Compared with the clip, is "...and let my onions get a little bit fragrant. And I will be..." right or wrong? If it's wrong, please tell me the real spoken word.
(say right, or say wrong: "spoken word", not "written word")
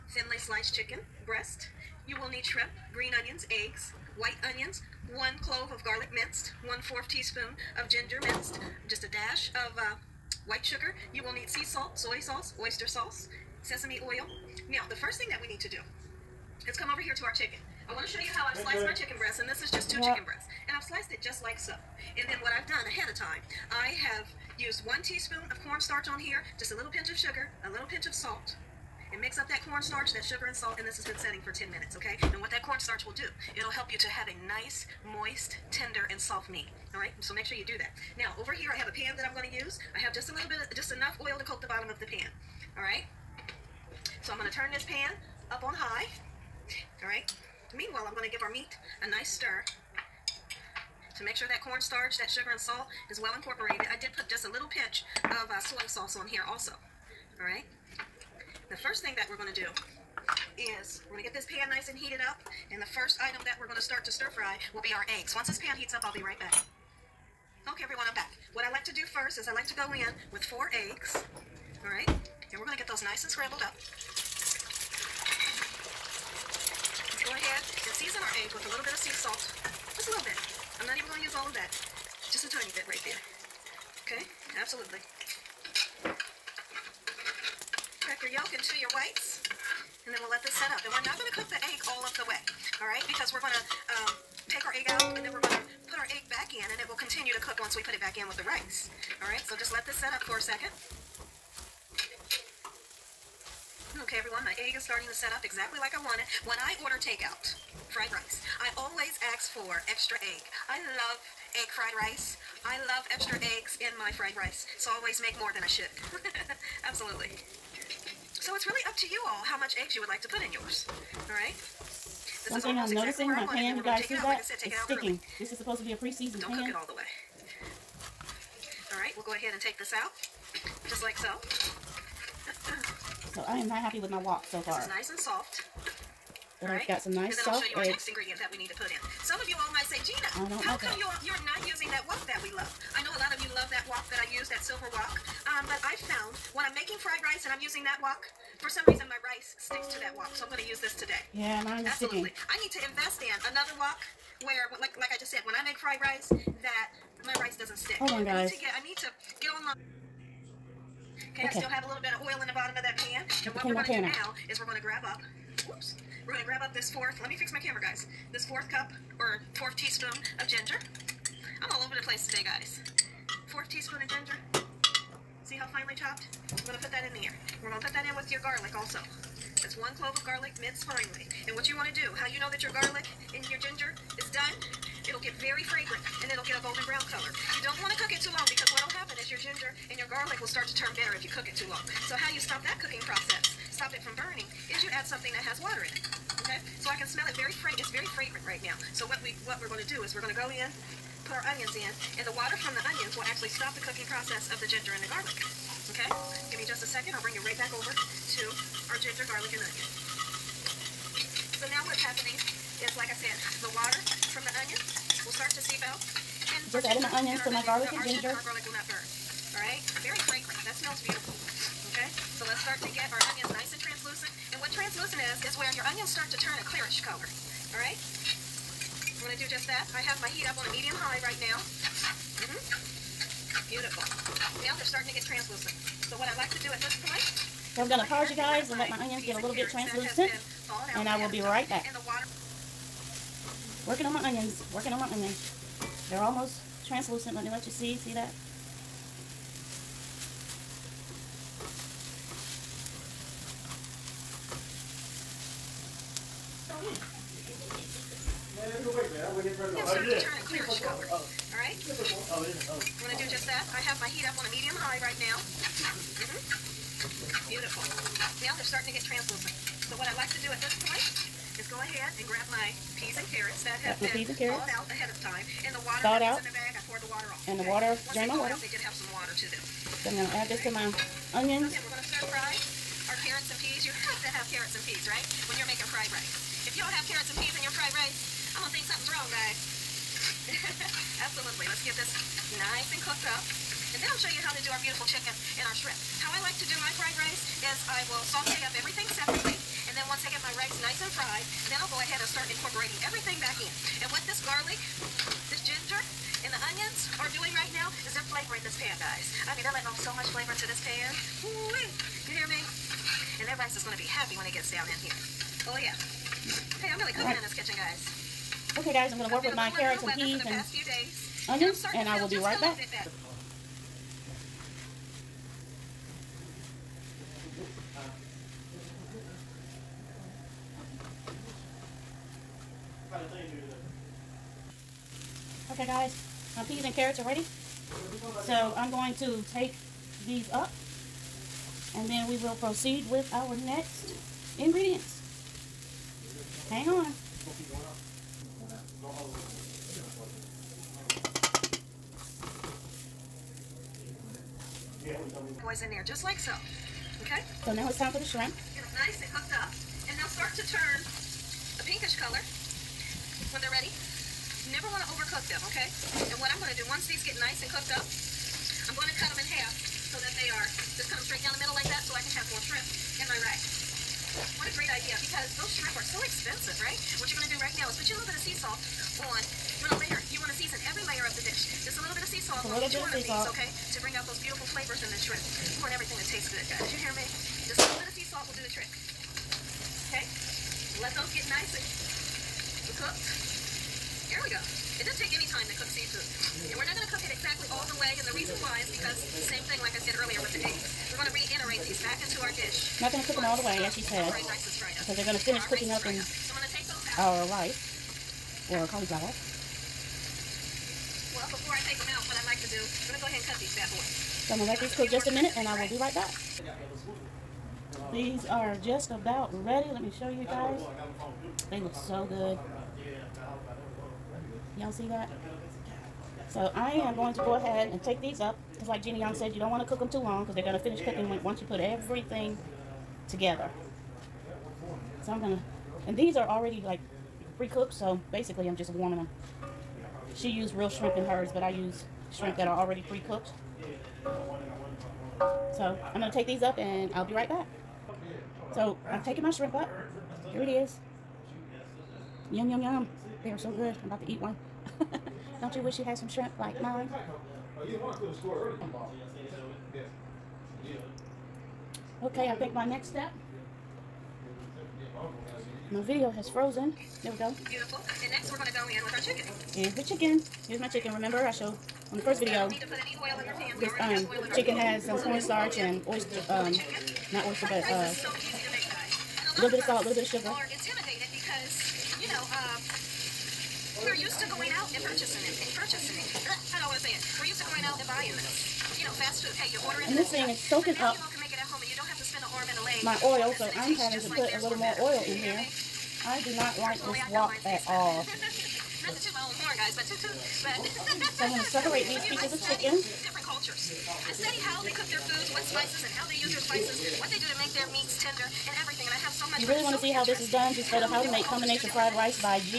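wrong: "translucent", not "fragrant".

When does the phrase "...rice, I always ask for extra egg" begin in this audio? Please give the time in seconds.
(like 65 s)
108 s.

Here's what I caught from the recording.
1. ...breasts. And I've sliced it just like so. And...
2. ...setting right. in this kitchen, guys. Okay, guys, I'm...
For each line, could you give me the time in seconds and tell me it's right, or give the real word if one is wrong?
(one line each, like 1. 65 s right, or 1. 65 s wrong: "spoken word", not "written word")
1. 20 s right
2. 317 s wrong: "cooking", not "setting".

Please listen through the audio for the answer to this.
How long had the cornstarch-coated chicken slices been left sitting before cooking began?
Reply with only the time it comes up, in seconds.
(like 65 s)
31 s.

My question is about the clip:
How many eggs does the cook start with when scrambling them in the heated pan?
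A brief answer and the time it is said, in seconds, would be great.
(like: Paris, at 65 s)
4, at 70 s.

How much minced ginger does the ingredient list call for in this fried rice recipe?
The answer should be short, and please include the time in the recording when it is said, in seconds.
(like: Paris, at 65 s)
1/4 teaspoon, at 6 s.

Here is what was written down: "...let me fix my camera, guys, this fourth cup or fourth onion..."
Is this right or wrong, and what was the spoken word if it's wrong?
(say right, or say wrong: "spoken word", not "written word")
wrong: "teaspoon", not "onion".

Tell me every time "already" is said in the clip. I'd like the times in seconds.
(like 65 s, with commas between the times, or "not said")
436 s, 442 s.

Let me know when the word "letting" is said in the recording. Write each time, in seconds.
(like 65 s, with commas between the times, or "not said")
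309 s.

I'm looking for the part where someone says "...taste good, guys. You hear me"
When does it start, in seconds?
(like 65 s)
386 s.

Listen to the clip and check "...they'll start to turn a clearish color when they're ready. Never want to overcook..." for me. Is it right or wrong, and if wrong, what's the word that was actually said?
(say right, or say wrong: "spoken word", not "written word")
wrong: "pinkish", not "clearish".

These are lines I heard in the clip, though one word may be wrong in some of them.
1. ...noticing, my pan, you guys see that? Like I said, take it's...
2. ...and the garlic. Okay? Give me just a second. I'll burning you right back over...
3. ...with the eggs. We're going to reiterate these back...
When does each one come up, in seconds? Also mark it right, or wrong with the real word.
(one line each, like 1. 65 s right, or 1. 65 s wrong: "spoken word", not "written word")
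1. 122 s right
2. 204 s wrong: "bring", not "burning"
3. 400 s right.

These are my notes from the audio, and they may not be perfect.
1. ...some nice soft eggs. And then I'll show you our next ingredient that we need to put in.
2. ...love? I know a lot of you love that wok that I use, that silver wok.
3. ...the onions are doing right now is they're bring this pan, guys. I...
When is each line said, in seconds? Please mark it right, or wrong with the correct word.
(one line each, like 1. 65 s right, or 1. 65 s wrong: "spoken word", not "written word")
1. 137 s right
2. 142 s right
3. 306 s wrong: "flavoring", not "bring".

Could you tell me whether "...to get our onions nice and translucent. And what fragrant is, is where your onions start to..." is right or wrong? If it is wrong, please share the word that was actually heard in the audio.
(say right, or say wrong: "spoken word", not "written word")
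wrong: "translucent", not "fragrant".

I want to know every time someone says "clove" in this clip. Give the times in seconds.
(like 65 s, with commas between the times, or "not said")
5 s, 179 s.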